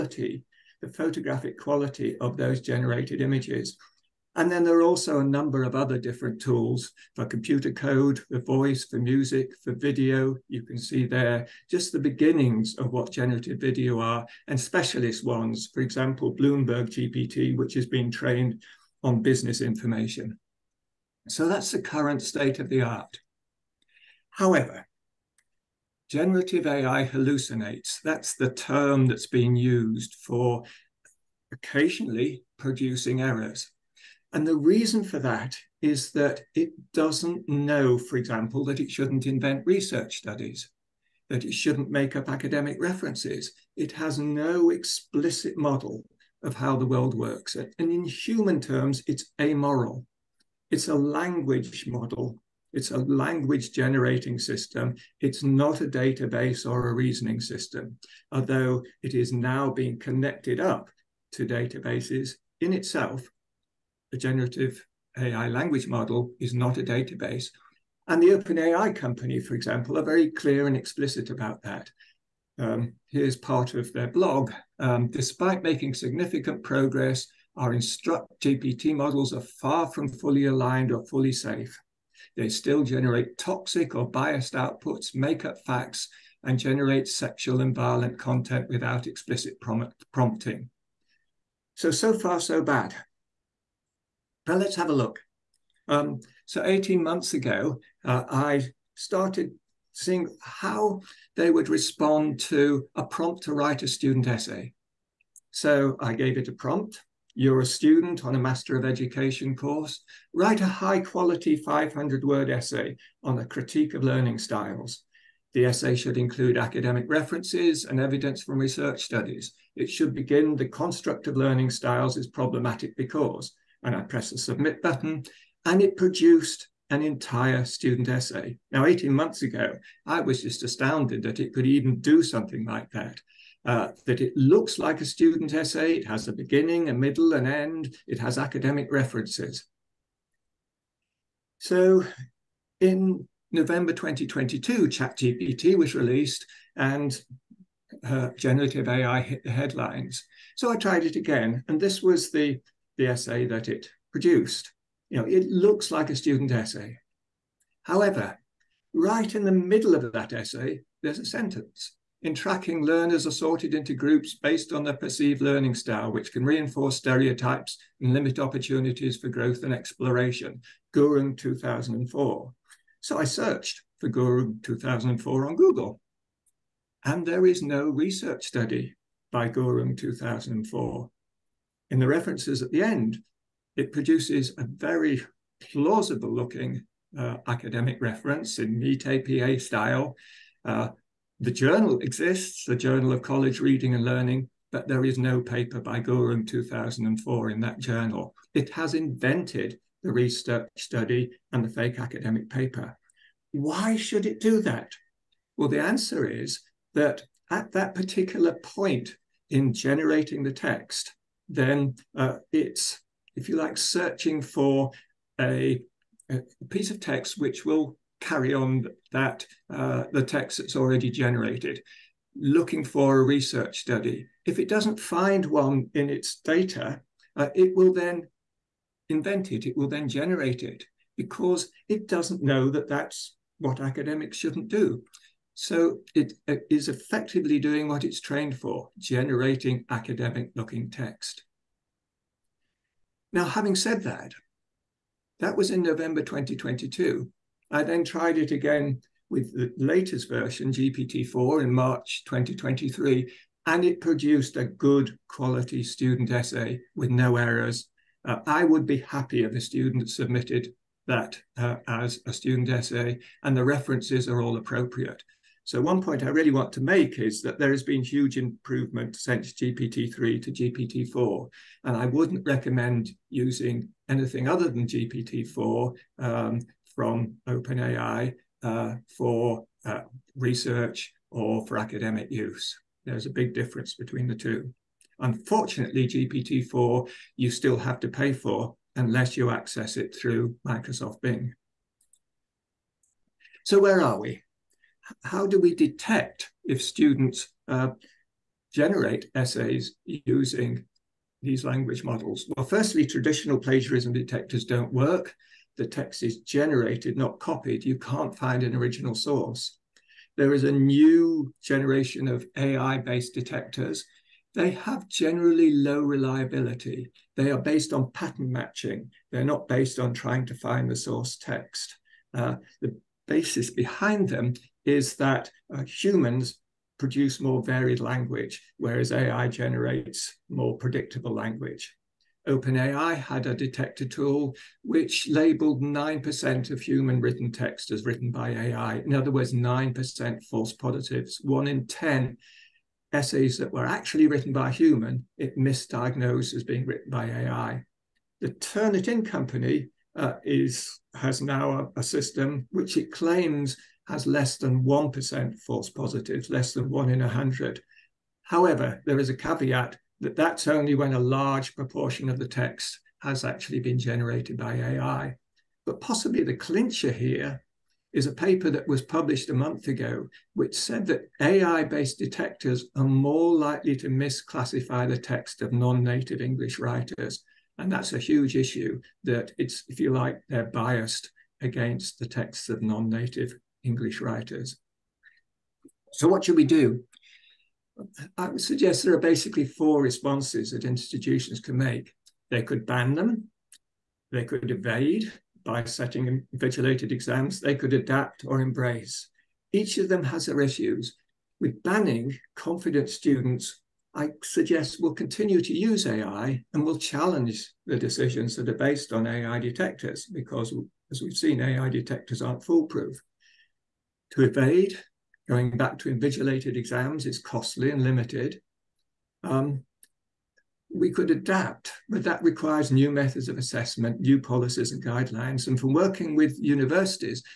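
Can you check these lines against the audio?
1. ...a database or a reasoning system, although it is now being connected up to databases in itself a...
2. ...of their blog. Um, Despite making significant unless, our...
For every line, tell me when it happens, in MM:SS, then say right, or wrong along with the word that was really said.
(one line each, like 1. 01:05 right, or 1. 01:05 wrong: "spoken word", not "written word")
1. 00:55 right
2. 01:13 wrong: "progress", not "unless".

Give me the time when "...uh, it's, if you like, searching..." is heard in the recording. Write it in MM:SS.
03:32.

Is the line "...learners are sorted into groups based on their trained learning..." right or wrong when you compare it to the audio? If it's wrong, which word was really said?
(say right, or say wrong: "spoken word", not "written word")
wrong: "perceived", not "trained".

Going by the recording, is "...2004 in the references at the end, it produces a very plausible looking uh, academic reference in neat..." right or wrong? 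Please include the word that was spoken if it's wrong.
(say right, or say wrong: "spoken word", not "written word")
right.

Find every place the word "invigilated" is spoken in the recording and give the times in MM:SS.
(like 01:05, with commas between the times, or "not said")
06:36, 06:56.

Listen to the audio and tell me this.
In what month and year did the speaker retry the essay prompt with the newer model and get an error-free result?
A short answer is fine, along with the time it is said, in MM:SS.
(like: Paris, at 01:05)
March 2023, at 04:11.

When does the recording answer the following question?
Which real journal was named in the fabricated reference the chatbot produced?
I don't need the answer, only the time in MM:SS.
03:12.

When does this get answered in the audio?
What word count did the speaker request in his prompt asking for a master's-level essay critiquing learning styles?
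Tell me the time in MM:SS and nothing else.
01:51.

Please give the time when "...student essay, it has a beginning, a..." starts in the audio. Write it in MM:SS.
02:15.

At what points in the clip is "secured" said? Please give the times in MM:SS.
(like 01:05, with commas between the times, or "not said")
not said.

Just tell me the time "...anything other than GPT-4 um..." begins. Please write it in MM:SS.
04:34.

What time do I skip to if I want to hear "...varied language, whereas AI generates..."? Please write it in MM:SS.
05:27.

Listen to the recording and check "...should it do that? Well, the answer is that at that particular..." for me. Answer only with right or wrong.
right.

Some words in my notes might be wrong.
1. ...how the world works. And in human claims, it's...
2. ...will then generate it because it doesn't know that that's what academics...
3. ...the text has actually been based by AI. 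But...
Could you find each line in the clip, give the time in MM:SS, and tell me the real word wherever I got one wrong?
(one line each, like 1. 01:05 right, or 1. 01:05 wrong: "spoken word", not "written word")
1. 00:46 wrong: "terms", not "claims"
2. 03:49 right
3. 06:02 wrong: "generated", not "based".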